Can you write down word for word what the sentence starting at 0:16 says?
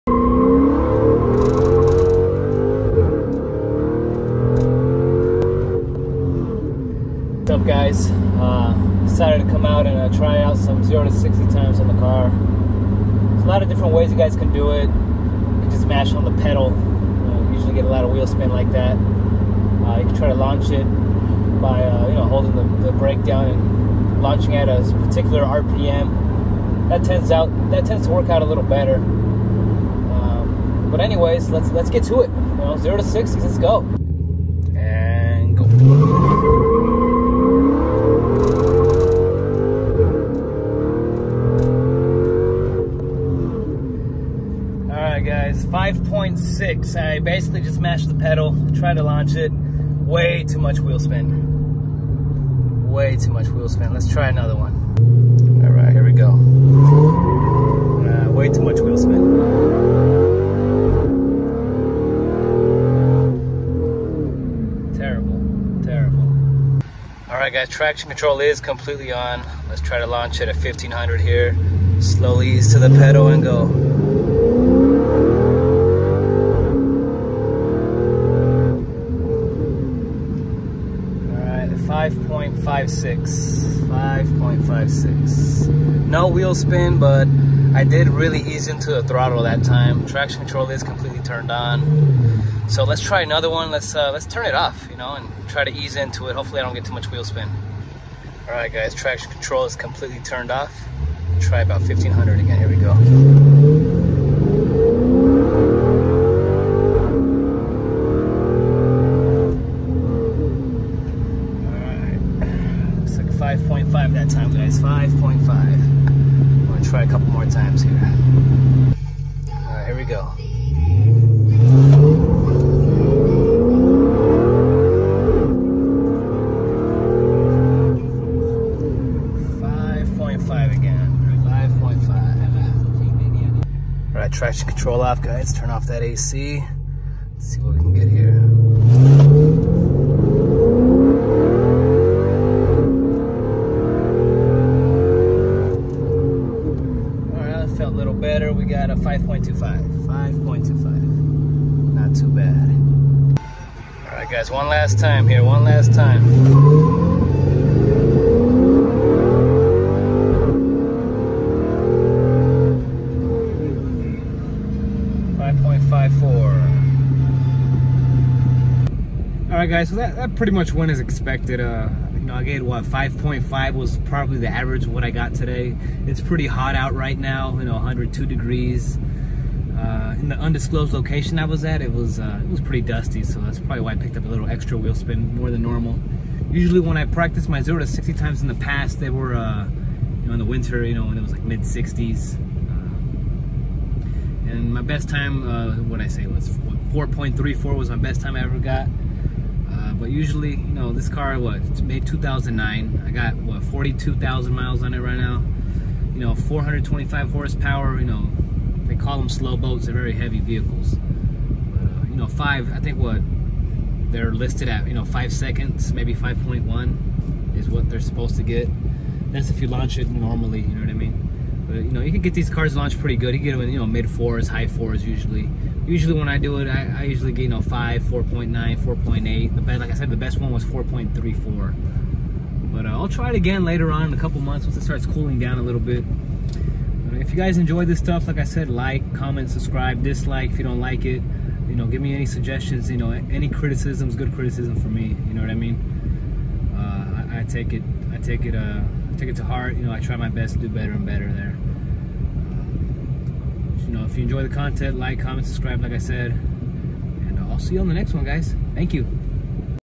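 Uh, usually get a lot of wheel spin like that.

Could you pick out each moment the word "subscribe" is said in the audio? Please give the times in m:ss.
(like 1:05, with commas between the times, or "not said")
3:59, 4:15.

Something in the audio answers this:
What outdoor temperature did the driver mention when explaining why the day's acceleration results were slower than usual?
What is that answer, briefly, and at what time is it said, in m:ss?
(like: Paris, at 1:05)
102 degrees, at 2:57.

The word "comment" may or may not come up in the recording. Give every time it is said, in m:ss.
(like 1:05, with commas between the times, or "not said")
3:59, 4:15.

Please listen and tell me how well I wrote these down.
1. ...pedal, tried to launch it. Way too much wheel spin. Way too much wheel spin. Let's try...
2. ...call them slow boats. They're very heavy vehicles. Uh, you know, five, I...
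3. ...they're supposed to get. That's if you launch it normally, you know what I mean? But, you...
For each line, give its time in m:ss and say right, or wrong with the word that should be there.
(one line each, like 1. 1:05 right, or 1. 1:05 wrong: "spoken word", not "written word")
1. 0:48 right
2. 3:28 right
3. 3:37 right.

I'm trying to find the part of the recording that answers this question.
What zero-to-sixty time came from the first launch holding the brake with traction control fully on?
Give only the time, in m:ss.
1:21.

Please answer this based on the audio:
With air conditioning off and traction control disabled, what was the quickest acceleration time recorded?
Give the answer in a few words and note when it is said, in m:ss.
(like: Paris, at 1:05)
5.25, at 2:28.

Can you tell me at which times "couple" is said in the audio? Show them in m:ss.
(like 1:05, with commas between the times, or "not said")
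1:57, 3:54.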